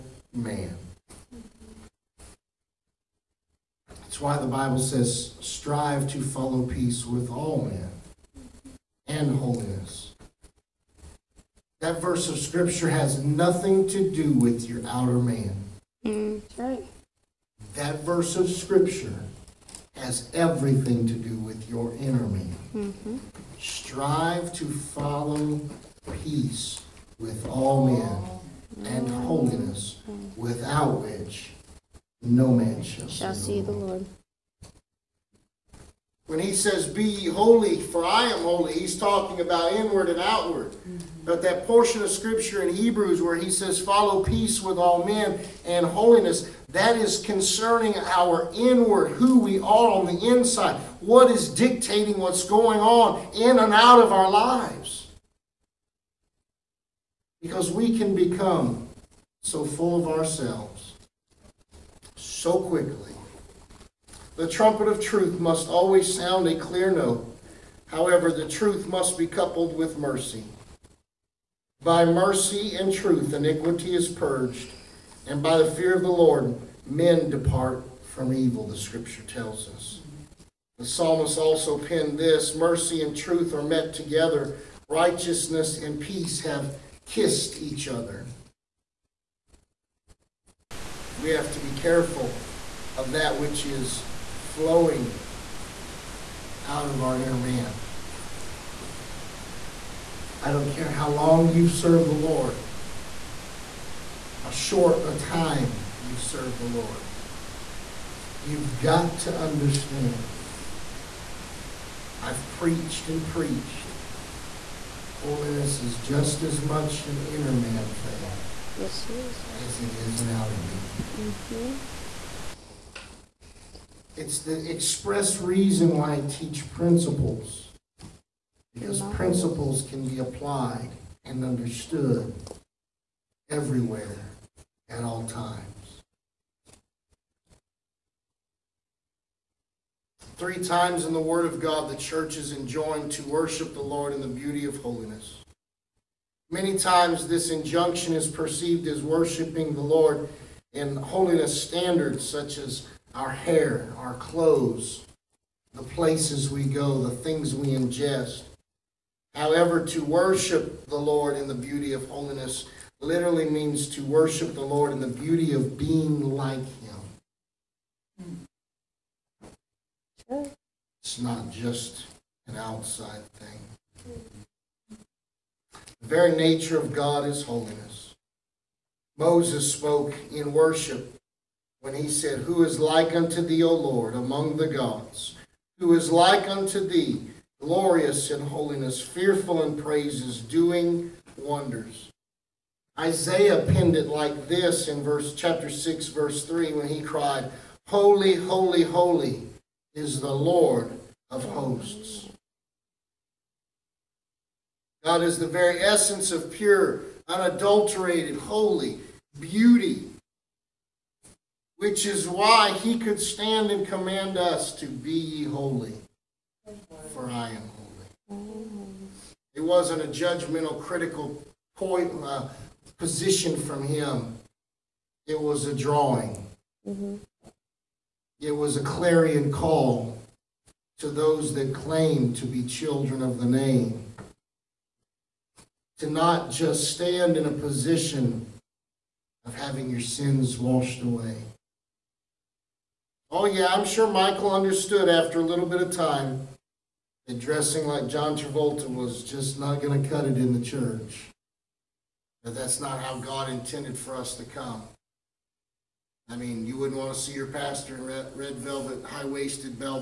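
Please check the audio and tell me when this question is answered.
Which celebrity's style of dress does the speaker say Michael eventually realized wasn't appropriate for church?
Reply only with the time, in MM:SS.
04:08.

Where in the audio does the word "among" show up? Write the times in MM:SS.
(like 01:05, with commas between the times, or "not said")
03:04.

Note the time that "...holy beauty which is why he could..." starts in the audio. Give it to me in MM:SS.
03:28.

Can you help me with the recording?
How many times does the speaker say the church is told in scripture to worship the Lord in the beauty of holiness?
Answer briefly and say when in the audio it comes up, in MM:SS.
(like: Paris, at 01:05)
3, at 02:20.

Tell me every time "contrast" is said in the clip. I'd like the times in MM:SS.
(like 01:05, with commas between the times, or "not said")
not said.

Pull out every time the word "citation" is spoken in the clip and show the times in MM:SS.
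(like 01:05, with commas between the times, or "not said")
not said.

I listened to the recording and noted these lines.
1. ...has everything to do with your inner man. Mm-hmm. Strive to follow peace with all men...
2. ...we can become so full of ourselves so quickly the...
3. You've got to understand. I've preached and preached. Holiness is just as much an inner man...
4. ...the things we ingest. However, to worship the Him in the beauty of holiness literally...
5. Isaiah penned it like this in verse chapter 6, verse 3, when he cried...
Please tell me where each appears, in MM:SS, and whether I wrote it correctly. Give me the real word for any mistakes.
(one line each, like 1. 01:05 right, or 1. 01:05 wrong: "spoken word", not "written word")
1. 00:19 right
2. 00:57 right
3. 01:48 right
4. 02:37 wrong: "Lord", not "Him"
5. 03:12 right.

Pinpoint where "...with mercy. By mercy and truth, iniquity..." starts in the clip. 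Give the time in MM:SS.
01:09.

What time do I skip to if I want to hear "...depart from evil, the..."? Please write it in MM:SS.
01:17.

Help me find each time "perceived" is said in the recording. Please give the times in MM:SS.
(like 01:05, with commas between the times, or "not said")
02:28.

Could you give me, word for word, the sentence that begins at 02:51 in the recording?
It's not just an outside thing.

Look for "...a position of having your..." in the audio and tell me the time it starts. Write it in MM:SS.
03:57.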